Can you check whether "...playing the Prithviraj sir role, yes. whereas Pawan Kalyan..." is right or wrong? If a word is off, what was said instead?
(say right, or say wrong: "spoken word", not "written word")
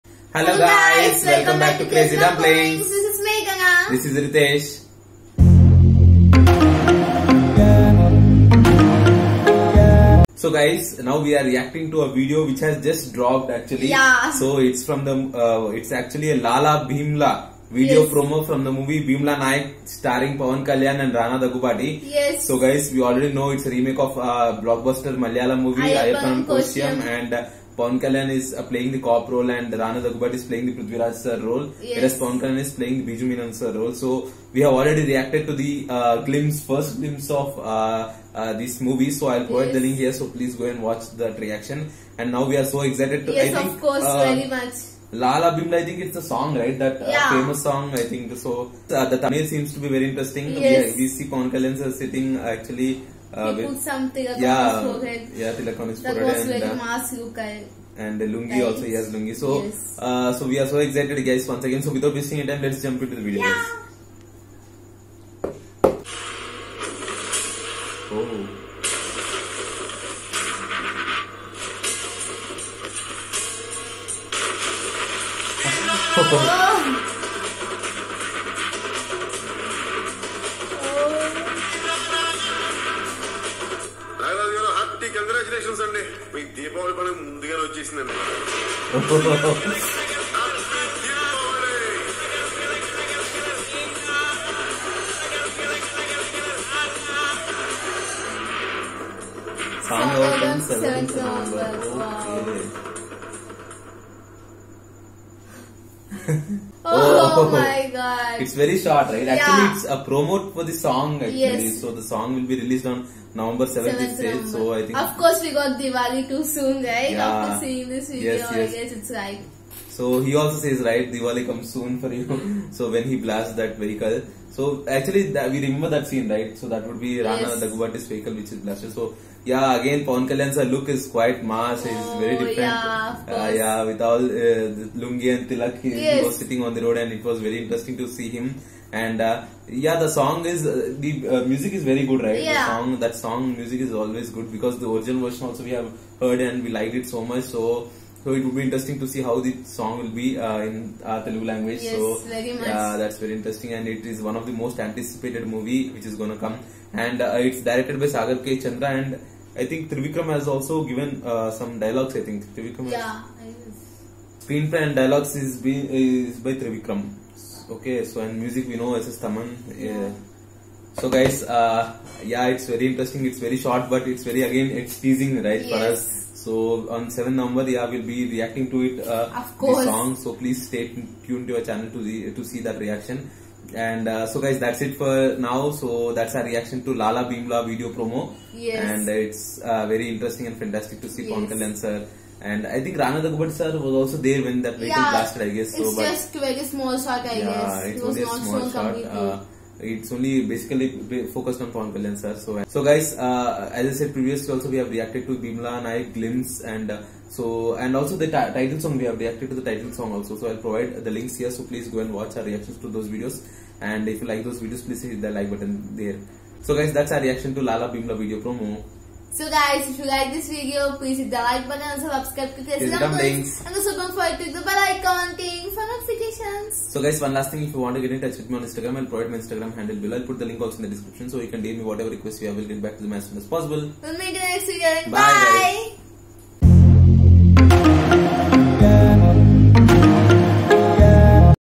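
right.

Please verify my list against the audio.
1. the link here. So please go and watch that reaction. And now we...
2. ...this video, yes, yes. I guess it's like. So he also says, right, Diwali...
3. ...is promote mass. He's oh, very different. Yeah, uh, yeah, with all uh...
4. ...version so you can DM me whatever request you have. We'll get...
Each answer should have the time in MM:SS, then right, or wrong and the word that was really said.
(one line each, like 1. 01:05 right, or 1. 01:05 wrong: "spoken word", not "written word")
1. 00:39 right
2. 01:57 right
3. 02:10 wrong: "quite", not "promote"
4. 03:50 wrong: "description", not "version".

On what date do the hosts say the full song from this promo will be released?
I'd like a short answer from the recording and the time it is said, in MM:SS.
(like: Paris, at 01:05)
November 7th, at 01:53.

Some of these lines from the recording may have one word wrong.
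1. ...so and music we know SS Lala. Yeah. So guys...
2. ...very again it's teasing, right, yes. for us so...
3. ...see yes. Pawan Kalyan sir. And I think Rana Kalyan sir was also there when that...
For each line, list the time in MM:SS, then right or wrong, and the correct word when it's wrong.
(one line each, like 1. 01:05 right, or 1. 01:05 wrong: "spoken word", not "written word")
1. 02:48 wrong: "Thaman", not "Lala"
2. 02:54 right
3. 03:11 wrong: "Daggubati", not "Kalyan".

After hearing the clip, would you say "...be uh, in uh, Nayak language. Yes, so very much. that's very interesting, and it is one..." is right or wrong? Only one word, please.
wrong.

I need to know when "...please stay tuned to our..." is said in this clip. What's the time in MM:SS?
03:00.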